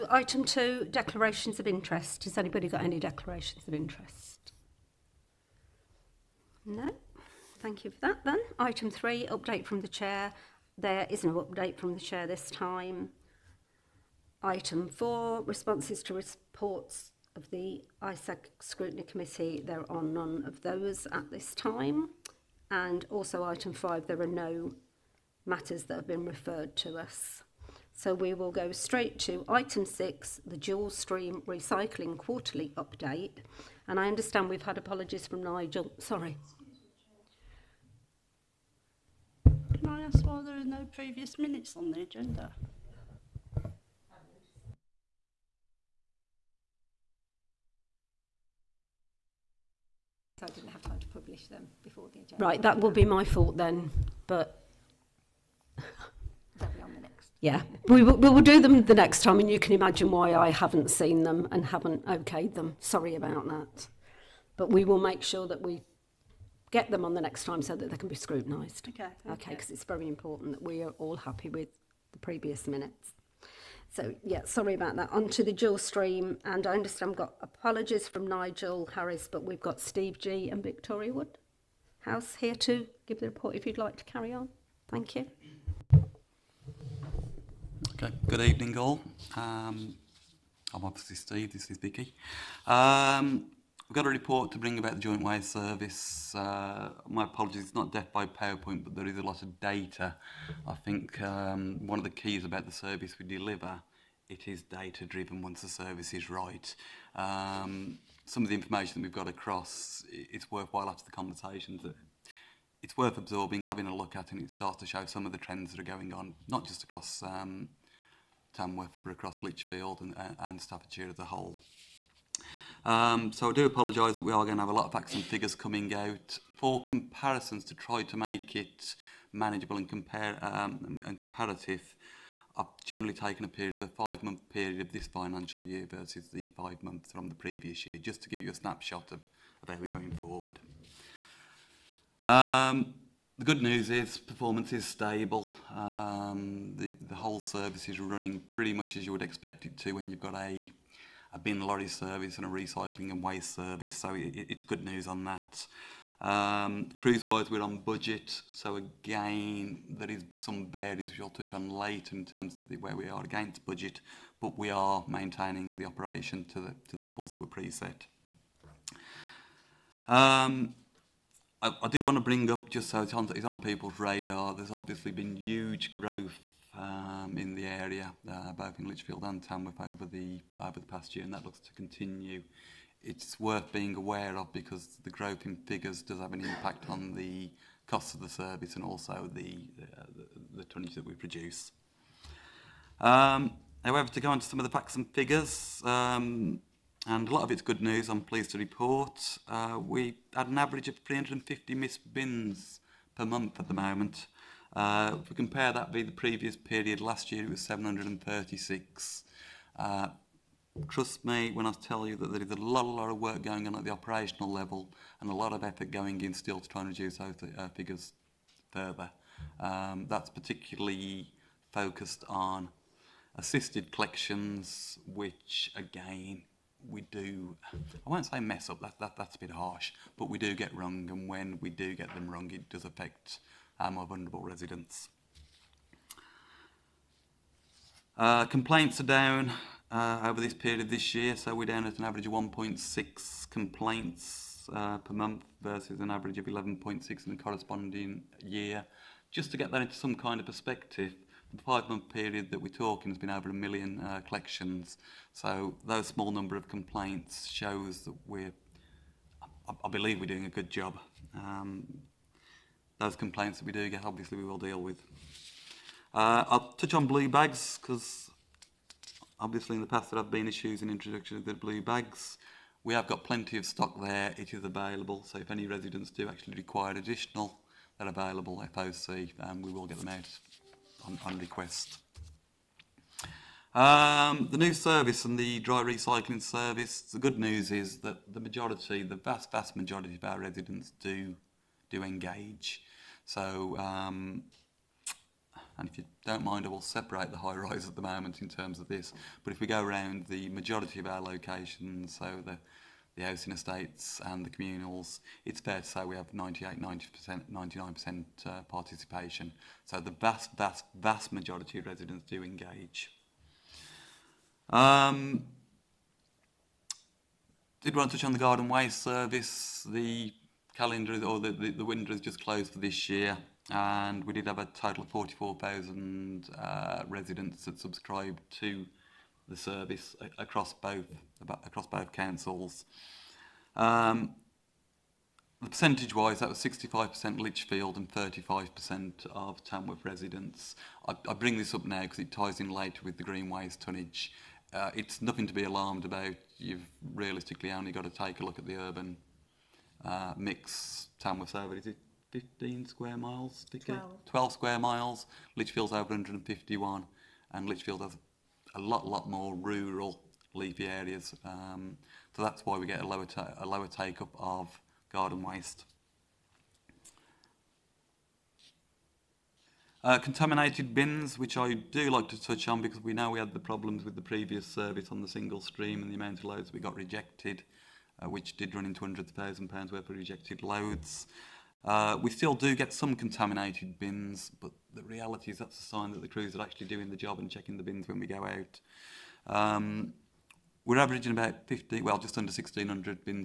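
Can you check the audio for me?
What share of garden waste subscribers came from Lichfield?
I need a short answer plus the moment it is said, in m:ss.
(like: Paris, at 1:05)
65%, at 5:36.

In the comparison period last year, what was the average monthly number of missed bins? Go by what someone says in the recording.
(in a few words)
736.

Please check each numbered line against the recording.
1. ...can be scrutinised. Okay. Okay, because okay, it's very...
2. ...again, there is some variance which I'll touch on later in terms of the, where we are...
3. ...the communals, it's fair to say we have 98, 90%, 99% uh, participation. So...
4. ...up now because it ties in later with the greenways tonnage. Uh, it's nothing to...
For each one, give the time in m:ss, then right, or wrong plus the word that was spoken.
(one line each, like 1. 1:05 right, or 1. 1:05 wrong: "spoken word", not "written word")
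1. 1:07 right
2. 2:38 right
3. 5:04 right
4. 5:41 right.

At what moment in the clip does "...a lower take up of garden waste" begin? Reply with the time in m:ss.
6:03.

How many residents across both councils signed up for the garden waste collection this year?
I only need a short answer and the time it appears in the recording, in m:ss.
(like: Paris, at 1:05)
44,000, at 5:25.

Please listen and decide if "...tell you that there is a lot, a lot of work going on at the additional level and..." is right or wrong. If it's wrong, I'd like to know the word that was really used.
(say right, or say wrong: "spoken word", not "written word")
wrong: "operational", not "additional".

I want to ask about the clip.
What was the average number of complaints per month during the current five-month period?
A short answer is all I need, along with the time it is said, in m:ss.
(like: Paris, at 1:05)
1.6, at 4:02.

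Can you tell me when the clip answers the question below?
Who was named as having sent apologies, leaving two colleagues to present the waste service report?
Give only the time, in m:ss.
1:18.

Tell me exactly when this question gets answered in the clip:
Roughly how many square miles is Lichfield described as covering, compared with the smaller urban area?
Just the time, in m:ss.
5:56.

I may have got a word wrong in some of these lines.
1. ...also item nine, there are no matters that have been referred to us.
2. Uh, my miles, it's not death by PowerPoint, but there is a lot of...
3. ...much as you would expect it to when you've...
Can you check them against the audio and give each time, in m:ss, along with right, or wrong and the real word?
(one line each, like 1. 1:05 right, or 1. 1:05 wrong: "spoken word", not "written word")
1. 0:23 wrong: "five", not "nine"
2. 1:36 wrong: "apologies", not "miles"
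3. 2:28 right.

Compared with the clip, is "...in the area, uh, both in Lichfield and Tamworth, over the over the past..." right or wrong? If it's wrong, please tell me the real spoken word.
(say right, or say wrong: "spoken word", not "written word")
right.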